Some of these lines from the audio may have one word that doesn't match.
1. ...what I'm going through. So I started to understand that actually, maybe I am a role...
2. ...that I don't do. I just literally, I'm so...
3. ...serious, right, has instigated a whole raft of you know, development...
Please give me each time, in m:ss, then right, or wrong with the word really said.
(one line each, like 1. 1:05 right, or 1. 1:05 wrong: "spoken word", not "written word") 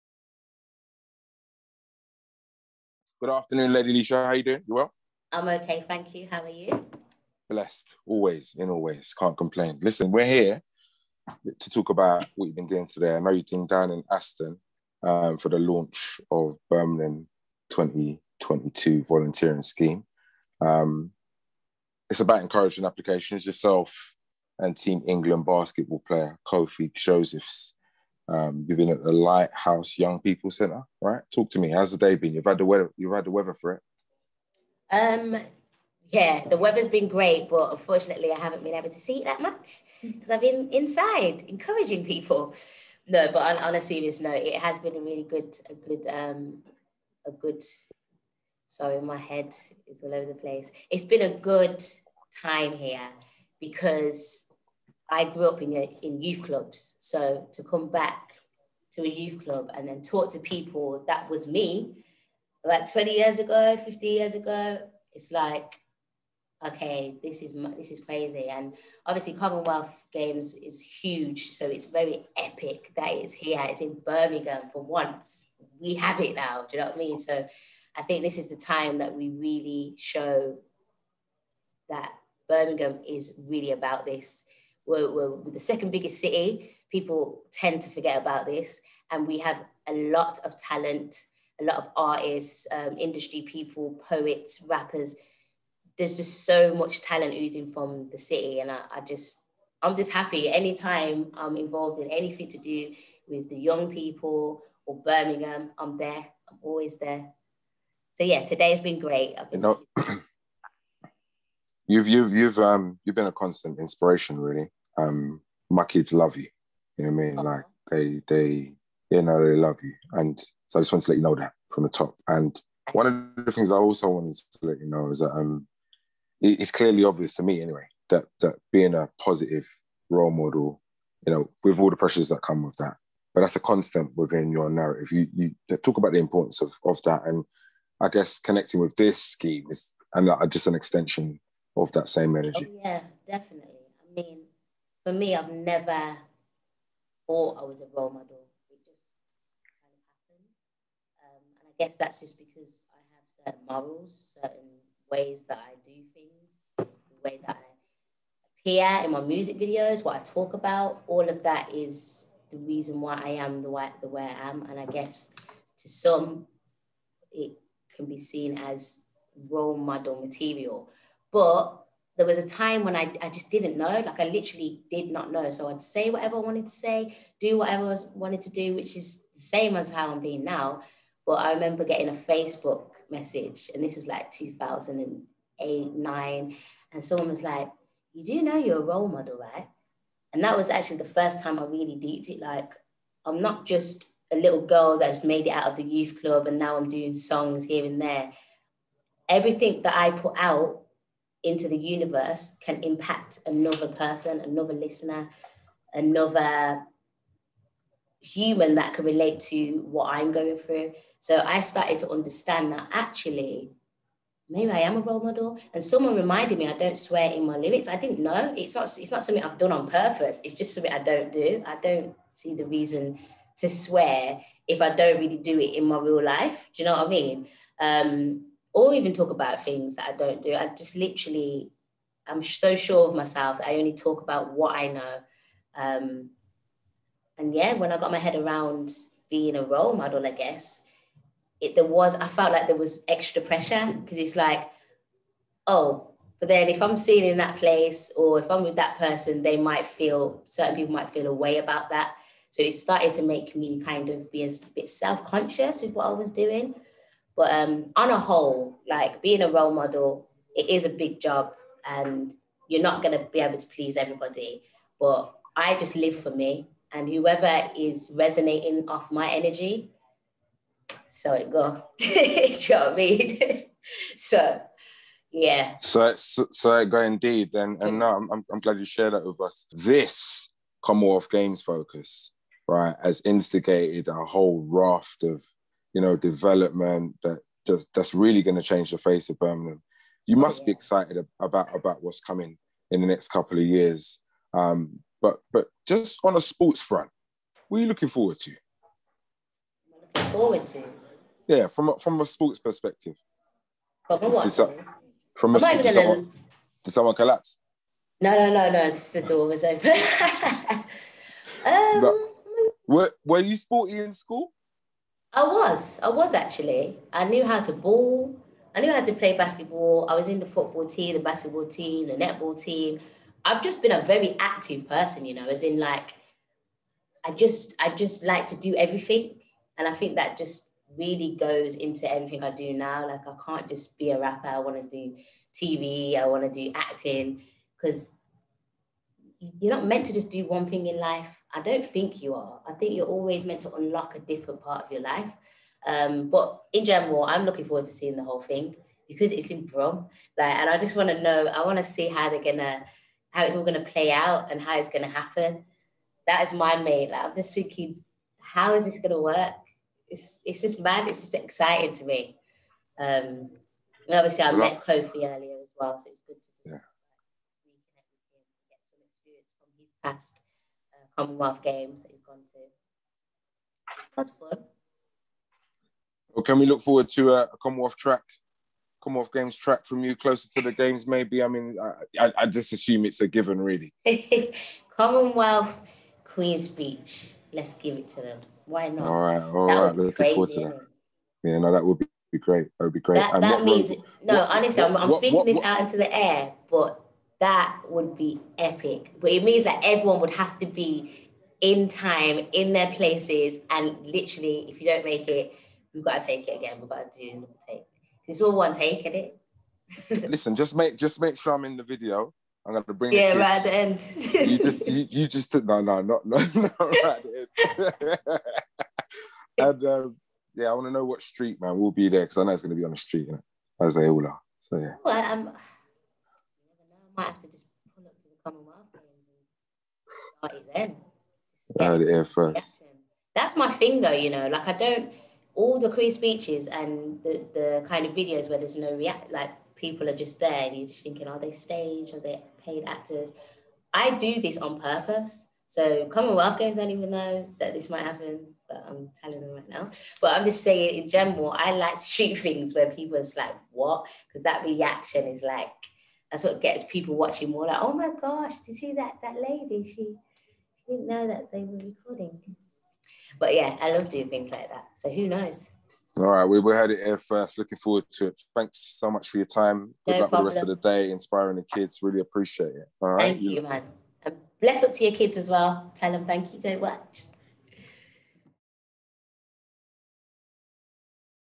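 1. 3:29 right
2. 3:49 right
3. 4:41 wrong: "focus", not "serious".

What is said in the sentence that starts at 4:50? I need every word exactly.
You must be excited about about what's coming in the next couple of years.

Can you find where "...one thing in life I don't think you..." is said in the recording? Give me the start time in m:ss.
5:40.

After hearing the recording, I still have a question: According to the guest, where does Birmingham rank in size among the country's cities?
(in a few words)
Second biggest.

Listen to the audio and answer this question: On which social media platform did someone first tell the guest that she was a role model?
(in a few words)
Facebook.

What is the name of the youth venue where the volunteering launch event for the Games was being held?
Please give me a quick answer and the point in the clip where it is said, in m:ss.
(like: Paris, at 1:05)
Lighthouse Young People Centre, at 0:29.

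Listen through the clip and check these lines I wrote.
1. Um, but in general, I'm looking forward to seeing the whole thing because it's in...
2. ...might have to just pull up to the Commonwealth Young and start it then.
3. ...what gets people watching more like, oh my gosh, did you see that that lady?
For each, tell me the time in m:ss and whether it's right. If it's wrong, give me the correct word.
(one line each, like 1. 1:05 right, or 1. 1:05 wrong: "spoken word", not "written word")
1. 5:45 right
2. 7:07 wrong: "Games", not "Young"
3. 7:36 right.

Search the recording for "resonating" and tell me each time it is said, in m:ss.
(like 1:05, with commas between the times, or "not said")
4:28.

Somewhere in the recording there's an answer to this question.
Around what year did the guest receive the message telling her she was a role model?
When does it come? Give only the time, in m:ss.
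3:04.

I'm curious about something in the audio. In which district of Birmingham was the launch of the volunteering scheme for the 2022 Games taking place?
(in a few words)
Aston.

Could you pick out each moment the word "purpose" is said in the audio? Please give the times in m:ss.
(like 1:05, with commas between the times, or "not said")
3:39, 7:24.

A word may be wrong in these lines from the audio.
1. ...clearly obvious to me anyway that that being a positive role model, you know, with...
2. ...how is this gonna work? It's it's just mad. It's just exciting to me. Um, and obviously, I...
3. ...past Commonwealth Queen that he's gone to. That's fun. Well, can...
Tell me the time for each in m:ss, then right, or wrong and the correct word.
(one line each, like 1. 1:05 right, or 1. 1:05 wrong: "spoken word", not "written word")
1. 2:06 right
2. 5:58 right
3. 6:10 wrong: "Games", not "Queen".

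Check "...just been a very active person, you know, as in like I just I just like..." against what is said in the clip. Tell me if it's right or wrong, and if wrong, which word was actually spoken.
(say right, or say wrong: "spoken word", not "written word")
right.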